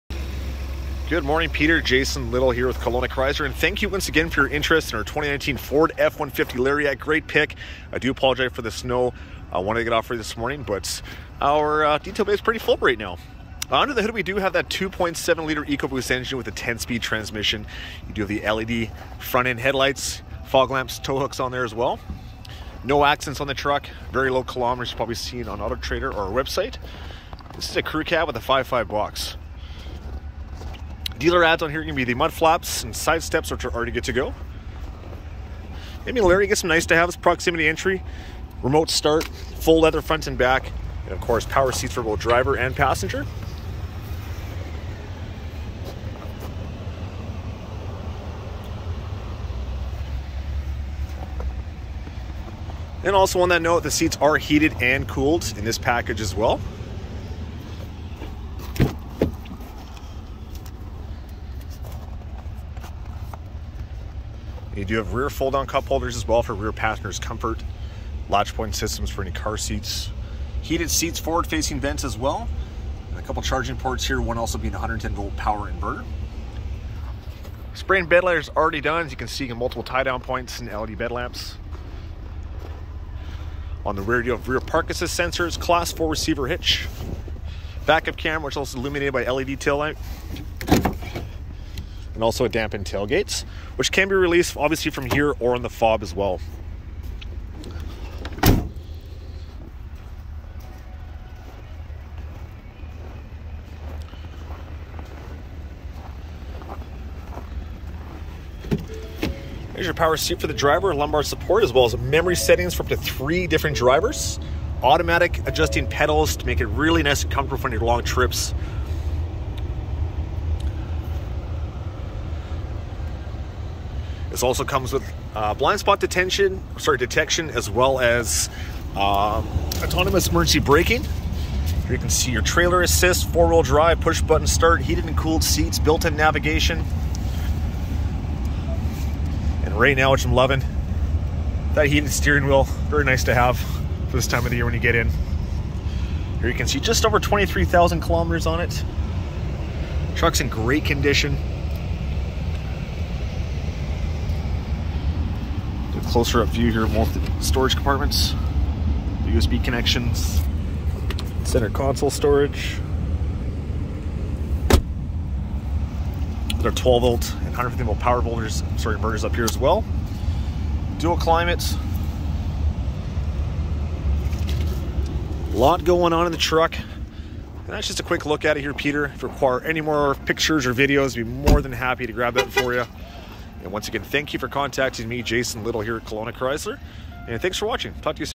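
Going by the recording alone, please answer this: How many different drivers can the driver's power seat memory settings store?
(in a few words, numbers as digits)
3.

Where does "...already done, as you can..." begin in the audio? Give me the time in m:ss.
1:18.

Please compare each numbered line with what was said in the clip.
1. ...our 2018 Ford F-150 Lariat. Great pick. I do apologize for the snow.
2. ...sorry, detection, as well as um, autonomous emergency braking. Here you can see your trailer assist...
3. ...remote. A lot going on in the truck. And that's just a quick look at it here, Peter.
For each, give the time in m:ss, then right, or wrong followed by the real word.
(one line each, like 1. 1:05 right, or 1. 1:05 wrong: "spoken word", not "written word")
1. 0:04 wrong: "2019", not "2018"
2. 2:06 right
3. 2:51 wrong: "climate", not "remote".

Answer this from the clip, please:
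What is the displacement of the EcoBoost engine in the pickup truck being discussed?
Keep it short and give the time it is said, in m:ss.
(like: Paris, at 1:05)
2.7 liter, at 0:14.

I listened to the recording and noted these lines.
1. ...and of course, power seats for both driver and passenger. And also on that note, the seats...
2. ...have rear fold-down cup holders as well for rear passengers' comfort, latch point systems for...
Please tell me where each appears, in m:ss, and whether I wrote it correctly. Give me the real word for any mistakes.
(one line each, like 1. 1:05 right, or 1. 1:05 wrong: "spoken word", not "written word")
1. 0:41 right
2. 1:04 right.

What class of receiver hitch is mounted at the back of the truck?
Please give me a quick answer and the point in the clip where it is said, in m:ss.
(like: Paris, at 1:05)
Class 4, at 1:25.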